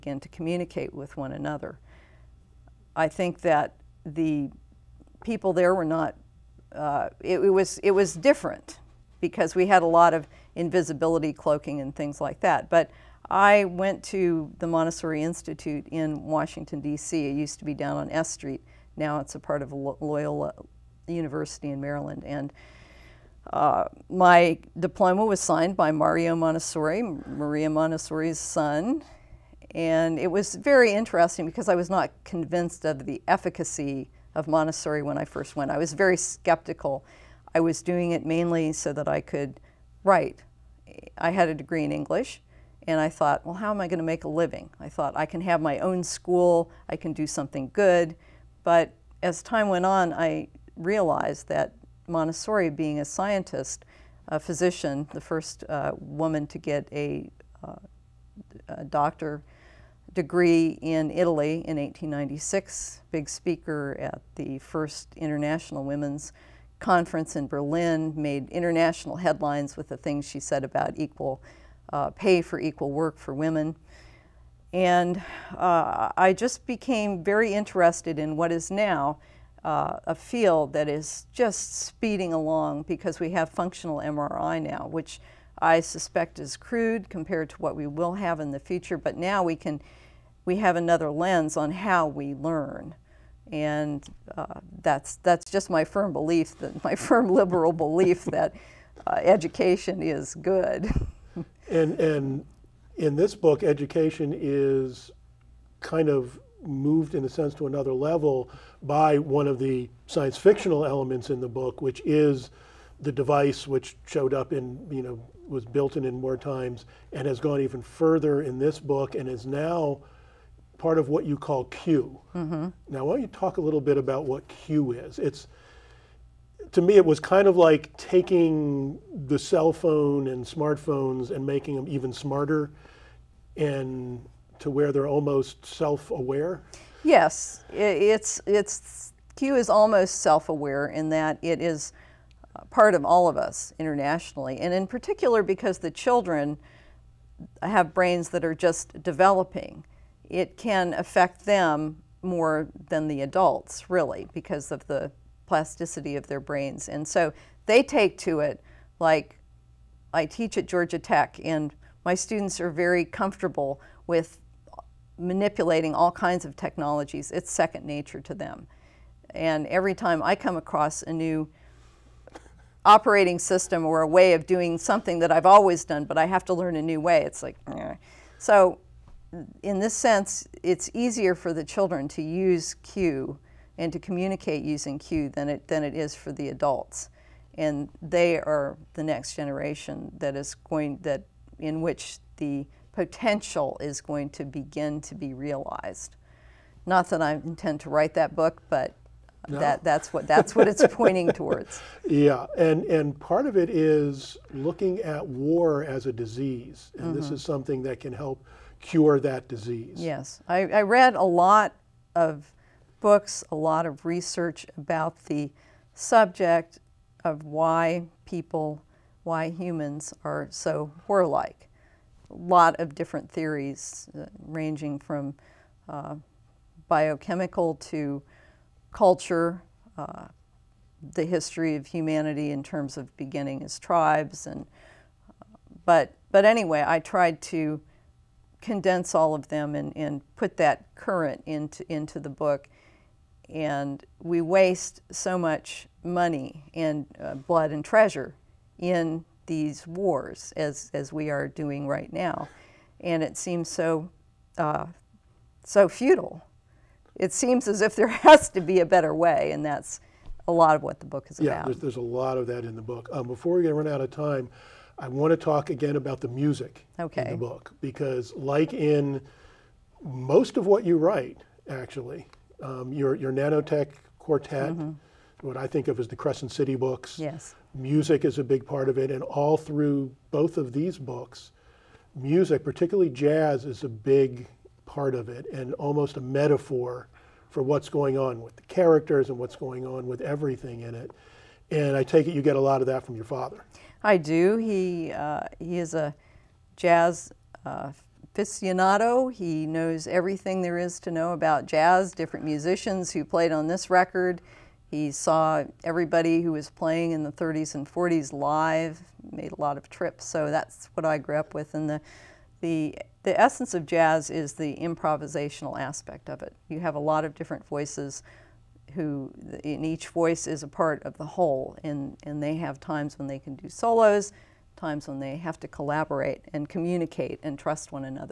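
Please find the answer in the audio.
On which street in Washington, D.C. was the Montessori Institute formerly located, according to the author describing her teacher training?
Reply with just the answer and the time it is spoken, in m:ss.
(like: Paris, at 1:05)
S Street, at 0:18.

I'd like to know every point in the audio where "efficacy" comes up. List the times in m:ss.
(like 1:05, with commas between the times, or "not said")
0:33.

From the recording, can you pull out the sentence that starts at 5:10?
So that's what I grew up with.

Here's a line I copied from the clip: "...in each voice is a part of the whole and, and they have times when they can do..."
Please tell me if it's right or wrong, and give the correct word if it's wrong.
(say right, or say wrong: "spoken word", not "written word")
right.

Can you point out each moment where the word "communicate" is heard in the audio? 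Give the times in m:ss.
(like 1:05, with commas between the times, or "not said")
0:00, 3:03, 5:26.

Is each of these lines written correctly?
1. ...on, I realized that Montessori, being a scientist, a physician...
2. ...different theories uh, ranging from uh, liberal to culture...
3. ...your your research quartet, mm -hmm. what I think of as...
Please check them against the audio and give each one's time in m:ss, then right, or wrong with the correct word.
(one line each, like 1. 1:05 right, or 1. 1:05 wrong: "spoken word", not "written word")
1. 0:49 right
2. 3:42 wrong: "biochemical", not "liberal"
3. 4:32 wrong: "nanotech", not "research".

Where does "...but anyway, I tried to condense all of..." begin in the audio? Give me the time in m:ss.
3:56.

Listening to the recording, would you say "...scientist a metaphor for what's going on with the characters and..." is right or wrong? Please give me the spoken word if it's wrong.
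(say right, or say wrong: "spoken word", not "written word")
wrong: "almost", not "scientist".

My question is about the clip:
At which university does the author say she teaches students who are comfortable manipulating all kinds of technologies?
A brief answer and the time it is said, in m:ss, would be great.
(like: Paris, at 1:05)
Georgia Tech, at 2:40.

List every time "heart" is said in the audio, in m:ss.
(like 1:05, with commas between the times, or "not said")
not said.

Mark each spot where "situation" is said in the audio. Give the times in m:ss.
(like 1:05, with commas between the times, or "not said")
not said.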